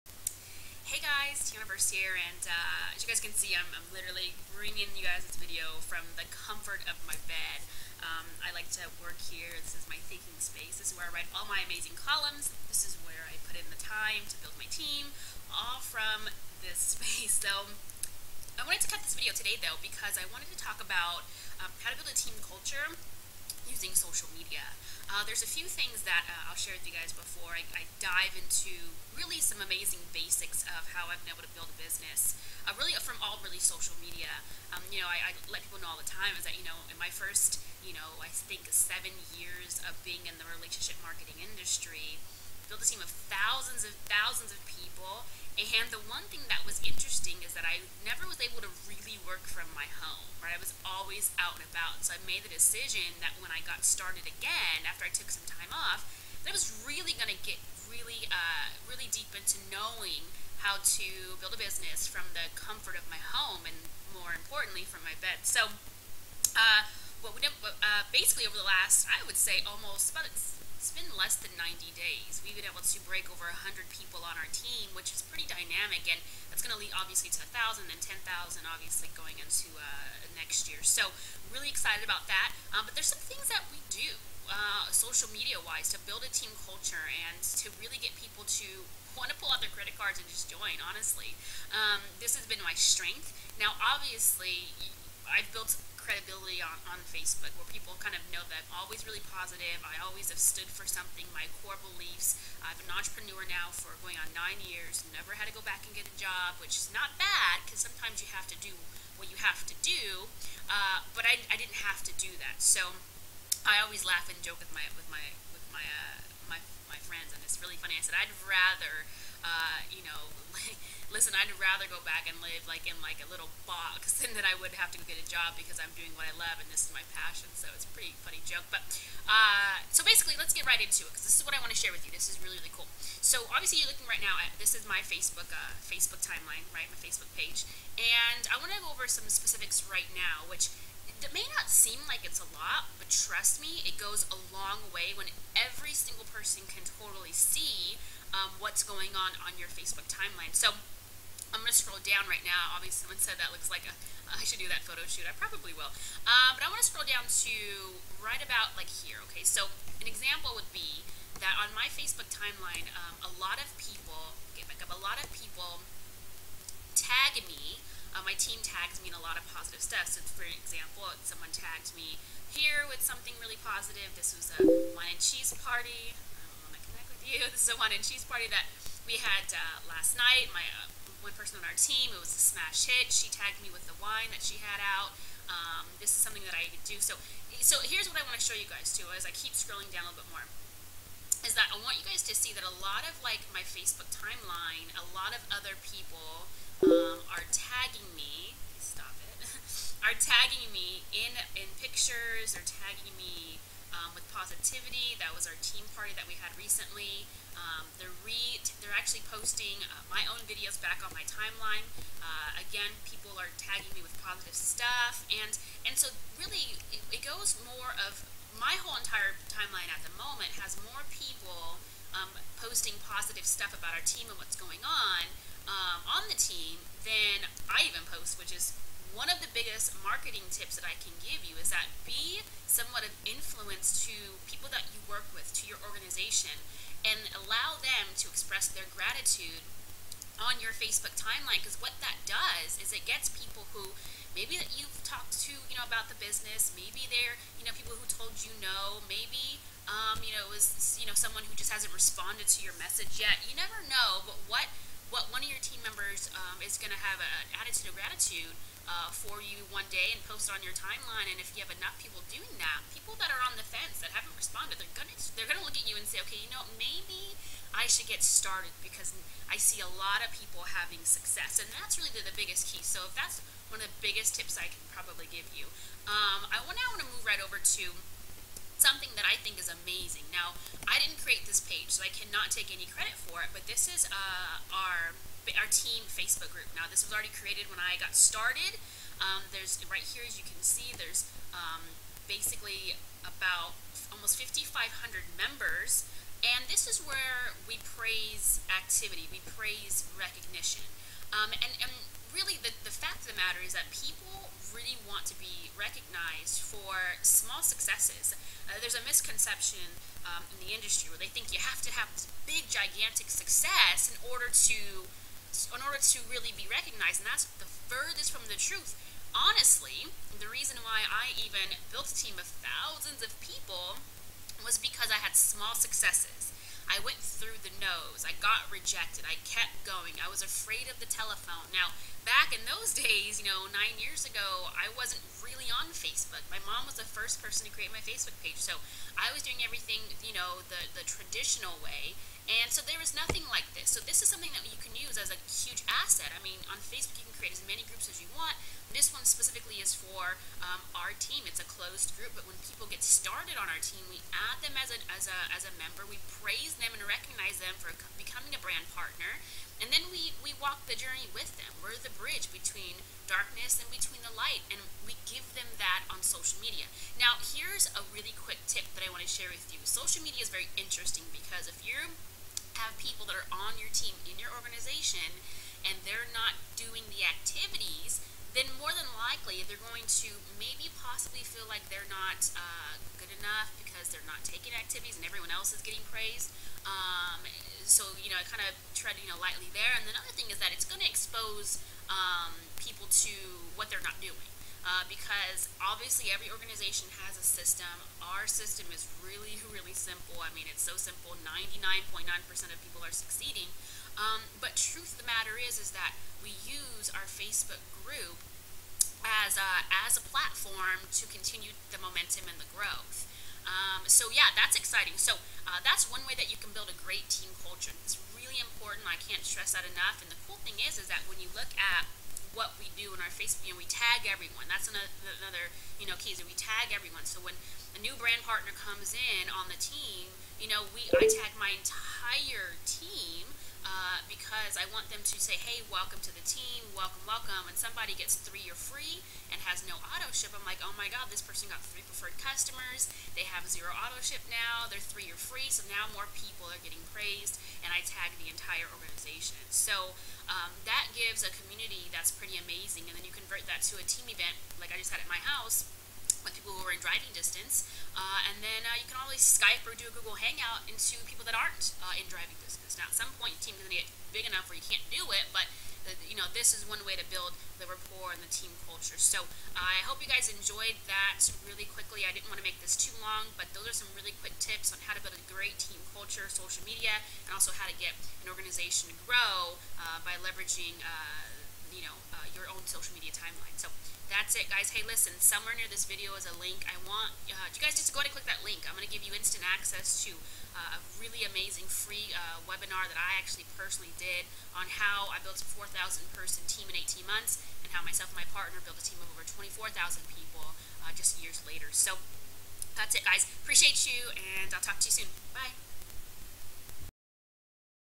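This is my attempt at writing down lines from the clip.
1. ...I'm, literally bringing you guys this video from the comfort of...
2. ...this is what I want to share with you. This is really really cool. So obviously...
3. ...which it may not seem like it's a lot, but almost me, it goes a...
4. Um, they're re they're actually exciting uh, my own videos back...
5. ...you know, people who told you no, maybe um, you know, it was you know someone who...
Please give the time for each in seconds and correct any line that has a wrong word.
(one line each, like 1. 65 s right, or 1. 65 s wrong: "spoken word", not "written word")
1. 3 s right
2. 131 s right
3. 140 s wrong: "trust", not "almost"
4. 207 s wrong: "posting", not "exciting"
5. 247 s right.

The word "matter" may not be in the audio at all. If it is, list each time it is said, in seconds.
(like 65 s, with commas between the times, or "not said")
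303 s, 405 s.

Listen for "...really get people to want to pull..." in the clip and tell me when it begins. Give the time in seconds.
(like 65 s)
87 s.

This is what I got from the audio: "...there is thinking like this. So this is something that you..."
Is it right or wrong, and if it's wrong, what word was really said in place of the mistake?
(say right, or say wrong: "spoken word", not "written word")
wrong: "nothing", not "thinking".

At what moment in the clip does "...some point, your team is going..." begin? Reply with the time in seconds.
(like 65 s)
463 s.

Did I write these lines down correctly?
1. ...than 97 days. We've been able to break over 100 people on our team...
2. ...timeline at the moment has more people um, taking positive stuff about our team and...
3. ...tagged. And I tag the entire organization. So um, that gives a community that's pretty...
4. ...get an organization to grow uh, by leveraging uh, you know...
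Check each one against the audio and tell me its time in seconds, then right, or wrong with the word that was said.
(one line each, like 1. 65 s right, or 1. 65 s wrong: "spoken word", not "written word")
1. 71 s wrong: "90", not "97"
2. 219 s wrong: "posting", not "taking"
3. 447 s wrong: "praised", not "tagged"
4. 477 s right.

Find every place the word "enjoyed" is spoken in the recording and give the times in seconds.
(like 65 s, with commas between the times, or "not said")
470 s.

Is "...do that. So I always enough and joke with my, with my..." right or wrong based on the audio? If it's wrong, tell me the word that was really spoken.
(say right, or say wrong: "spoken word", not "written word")
wrong: "laugh", not "enough".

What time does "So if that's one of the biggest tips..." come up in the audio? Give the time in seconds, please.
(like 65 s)
272 s.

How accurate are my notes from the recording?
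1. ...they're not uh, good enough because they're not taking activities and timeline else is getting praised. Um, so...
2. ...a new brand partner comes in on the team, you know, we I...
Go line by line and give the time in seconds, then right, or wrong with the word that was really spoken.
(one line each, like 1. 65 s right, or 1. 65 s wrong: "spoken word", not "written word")
1. 381 s wrong: "everyone", not "timeline"
2. 427 s right.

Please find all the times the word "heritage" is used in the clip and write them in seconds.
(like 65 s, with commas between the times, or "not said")
not said.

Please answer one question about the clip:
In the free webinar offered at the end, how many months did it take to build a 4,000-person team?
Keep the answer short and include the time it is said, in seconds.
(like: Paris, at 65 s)
18, at 496 s.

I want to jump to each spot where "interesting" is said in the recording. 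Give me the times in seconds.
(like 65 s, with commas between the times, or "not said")
46 s, 370 s.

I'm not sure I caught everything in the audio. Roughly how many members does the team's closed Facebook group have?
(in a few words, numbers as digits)
5,500.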